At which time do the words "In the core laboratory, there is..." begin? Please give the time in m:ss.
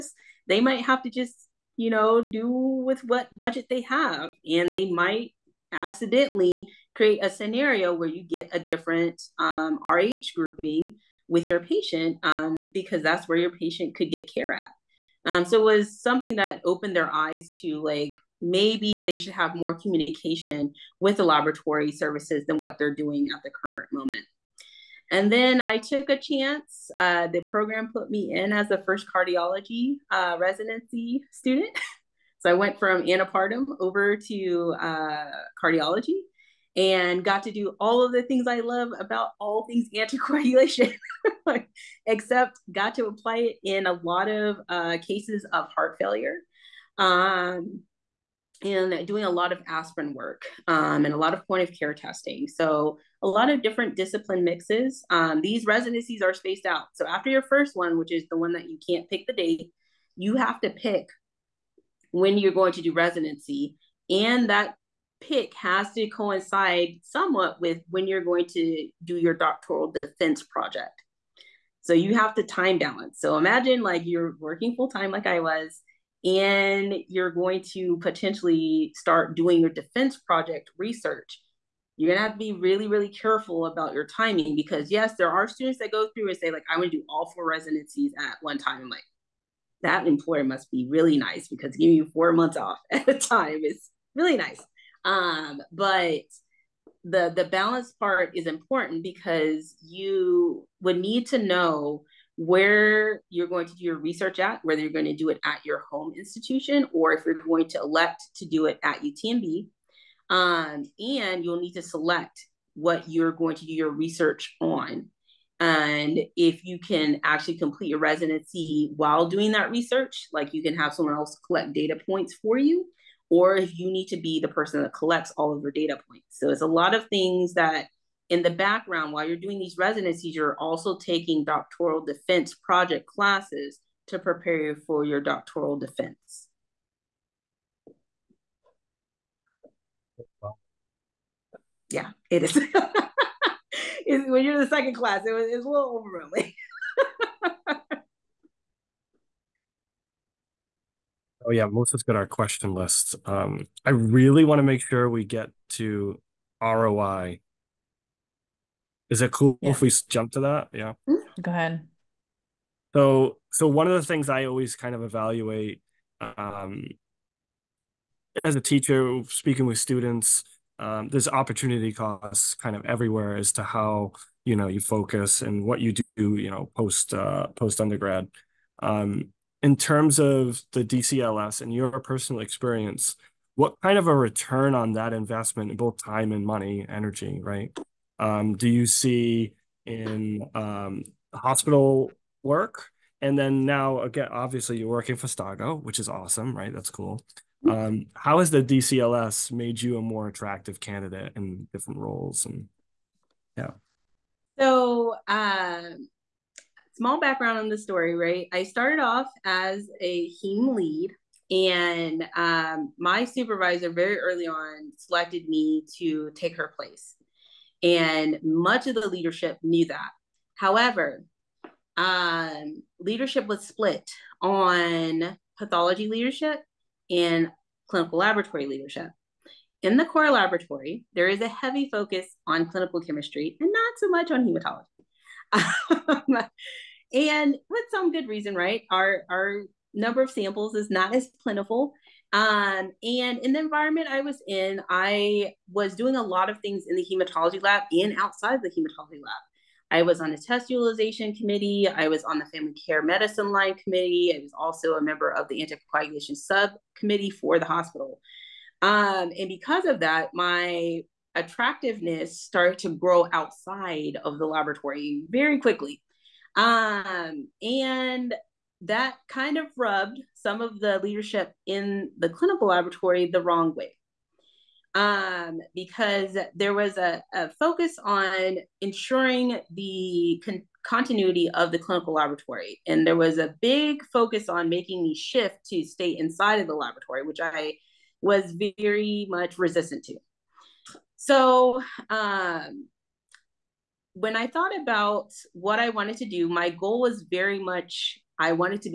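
3:49.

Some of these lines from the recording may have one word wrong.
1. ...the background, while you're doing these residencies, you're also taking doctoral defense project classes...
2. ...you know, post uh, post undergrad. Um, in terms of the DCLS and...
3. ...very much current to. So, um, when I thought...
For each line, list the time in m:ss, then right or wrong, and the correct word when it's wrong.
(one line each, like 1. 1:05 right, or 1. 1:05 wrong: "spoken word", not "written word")
1. 2:08 right
2. 2:56 right
3. 4:48 wrong: "resistant", not "current".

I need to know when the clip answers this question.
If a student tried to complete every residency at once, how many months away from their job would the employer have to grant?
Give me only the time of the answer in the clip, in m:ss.
1:32.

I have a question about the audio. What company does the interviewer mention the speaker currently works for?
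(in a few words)
Stago.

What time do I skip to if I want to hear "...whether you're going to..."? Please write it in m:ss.
1:44.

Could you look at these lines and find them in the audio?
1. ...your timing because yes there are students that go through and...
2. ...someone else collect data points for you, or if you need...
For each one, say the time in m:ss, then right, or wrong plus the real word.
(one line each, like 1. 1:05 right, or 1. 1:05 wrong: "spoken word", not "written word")
1. 1:23 right
2. 2:00 right.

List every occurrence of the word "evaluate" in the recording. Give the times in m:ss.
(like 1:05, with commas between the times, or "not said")
2:45.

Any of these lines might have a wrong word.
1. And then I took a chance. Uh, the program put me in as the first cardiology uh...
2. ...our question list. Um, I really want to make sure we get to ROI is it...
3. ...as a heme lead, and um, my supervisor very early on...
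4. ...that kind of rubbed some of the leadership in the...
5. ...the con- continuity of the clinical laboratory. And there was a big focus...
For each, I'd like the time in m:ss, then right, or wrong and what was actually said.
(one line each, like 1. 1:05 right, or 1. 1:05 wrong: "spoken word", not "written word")
1. 0:25 right
2. 2:32 right
3. 3:29 right
4. 4:28 right
5. 4:39 right.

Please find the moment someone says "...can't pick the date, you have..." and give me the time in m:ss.
0:58.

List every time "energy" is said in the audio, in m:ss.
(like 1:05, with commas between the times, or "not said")
3:06.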